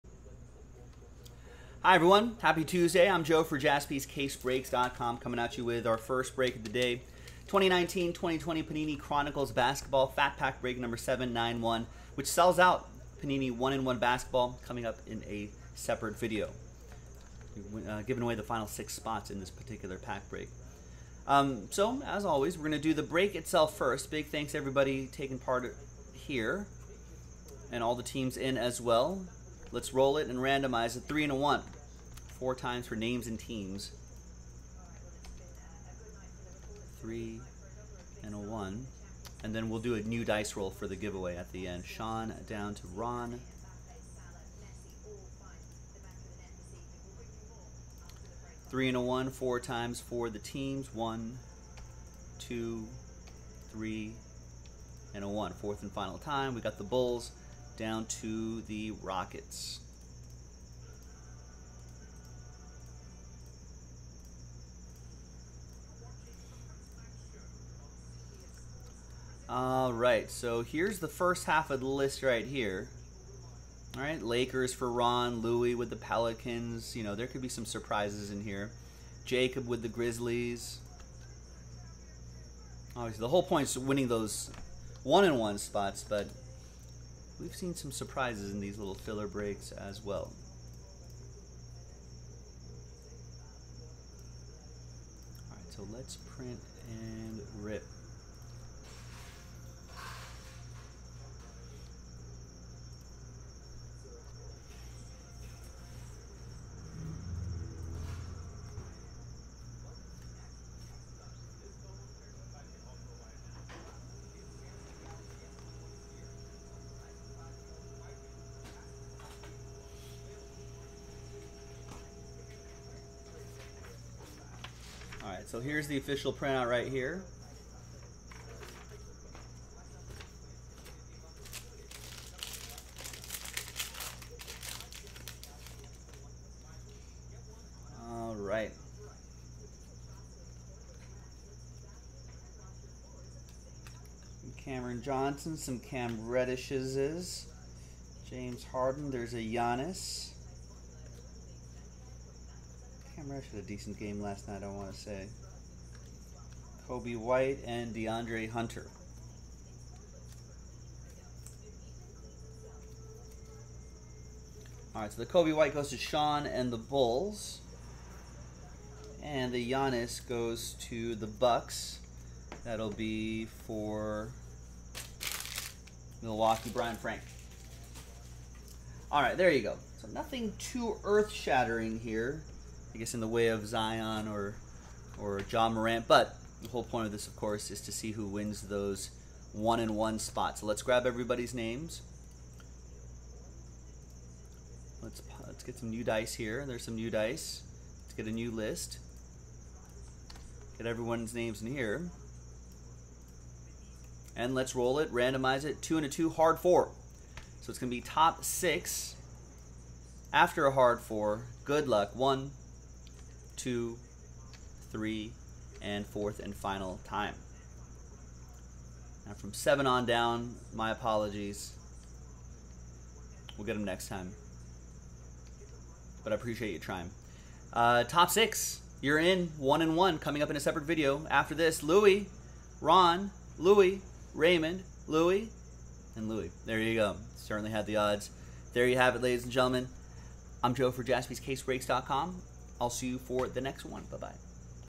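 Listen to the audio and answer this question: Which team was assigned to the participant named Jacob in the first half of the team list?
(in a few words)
Grizzlies.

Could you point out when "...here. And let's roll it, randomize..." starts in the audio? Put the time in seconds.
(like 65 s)
201 s.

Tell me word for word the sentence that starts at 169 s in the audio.
And the Giannis goes to the Bucks.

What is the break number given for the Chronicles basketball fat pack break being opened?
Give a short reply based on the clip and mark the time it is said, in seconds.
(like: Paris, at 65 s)
791, at 10 s.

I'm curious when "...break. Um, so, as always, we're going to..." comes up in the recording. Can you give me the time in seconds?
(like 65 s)
20 s.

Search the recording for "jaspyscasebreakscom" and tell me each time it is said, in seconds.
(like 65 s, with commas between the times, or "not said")
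3 s, 241 s.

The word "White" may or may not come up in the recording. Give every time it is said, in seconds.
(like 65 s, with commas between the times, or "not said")
157 s, 165 s.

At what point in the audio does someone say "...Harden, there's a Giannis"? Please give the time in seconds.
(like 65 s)
148 s.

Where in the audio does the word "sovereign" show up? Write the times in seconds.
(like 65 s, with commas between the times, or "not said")
not said.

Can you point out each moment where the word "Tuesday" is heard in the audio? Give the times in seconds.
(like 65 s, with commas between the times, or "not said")
2 s.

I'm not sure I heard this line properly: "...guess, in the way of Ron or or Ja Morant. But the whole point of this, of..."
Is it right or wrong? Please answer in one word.
wrong.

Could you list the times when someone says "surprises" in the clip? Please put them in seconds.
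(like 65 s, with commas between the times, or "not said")
77 s, 87 s.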